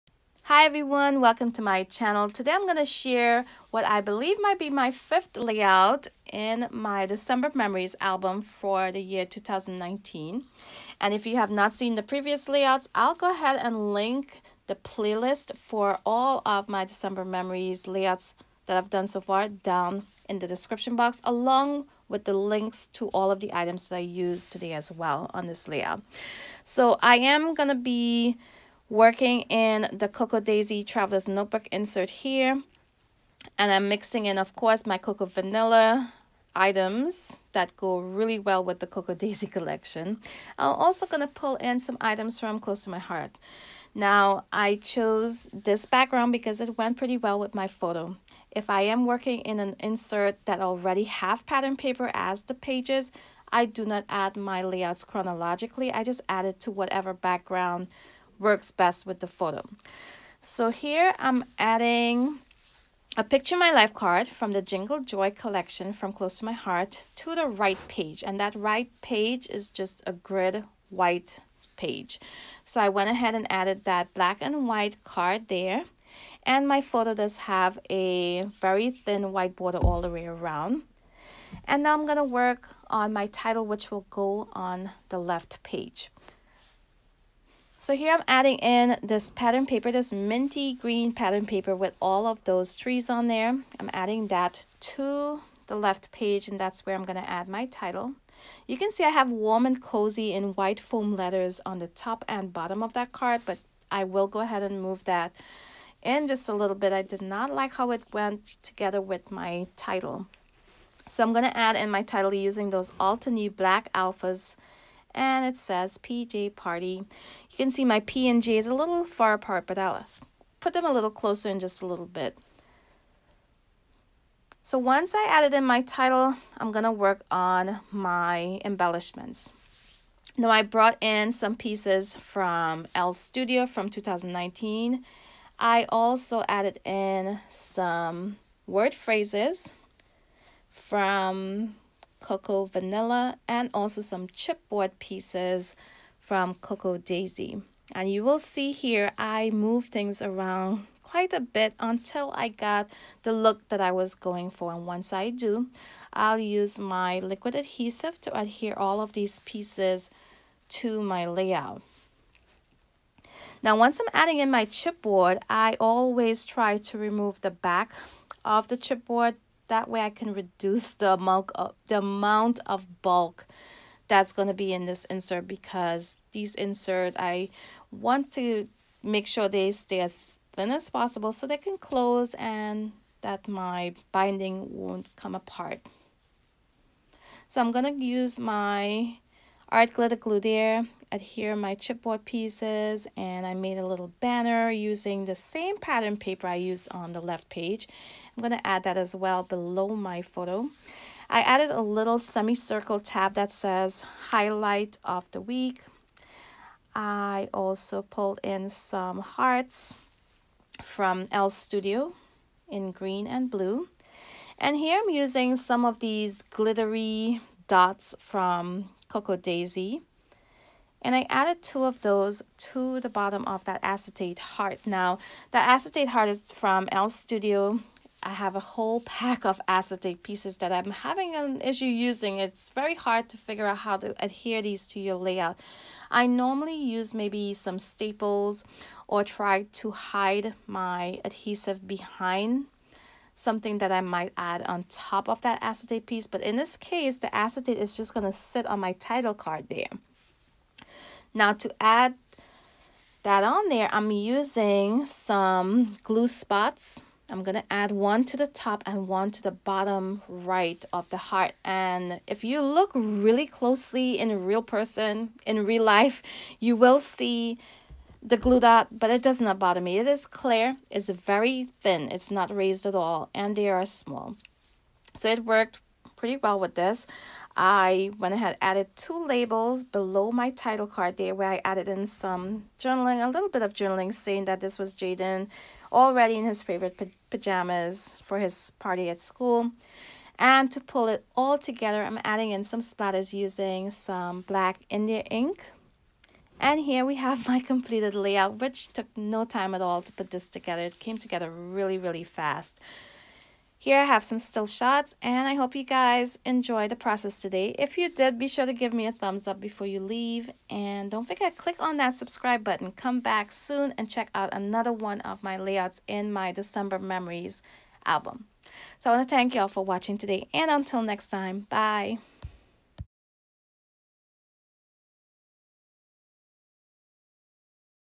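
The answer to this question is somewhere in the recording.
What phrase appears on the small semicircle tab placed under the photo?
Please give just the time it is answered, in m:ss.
3:24.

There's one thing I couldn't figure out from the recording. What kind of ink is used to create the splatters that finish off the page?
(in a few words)
black India ink.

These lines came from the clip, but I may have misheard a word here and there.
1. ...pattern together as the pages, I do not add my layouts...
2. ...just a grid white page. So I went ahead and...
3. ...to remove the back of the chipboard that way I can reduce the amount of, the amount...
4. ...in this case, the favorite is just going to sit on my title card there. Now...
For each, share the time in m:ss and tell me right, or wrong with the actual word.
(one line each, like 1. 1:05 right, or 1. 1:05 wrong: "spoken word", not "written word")
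1. 0:51 wrong: "paper", not "together"
2. 1:09 right
3. 2:46 right
4. 4:06 wrong: "acetate", not "favorite".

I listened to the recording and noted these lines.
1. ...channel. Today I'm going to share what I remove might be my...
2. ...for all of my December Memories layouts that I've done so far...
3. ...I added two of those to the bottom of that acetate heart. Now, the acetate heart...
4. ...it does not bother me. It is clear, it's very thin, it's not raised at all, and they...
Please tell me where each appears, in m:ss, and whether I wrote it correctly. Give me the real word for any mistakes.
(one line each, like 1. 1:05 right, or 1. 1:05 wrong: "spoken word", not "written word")
1. 0:01 wrong: "believe", not "remove"
2. 0:15 right
3. 3:41 right
4. 4:29 right.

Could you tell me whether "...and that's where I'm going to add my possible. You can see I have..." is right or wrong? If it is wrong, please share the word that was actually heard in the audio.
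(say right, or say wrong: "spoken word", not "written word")
wrong: "title", not "possible".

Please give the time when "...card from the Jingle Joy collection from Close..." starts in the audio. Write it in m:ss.
1:03.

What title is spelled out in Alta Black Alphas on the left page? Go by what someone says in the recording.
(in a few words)
PJ Party.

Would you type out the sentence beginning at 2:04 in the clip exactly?
So once I added in my title, I'm going to work on my embellishments.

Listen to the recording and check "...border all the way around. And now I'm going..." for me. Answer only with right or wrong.
right.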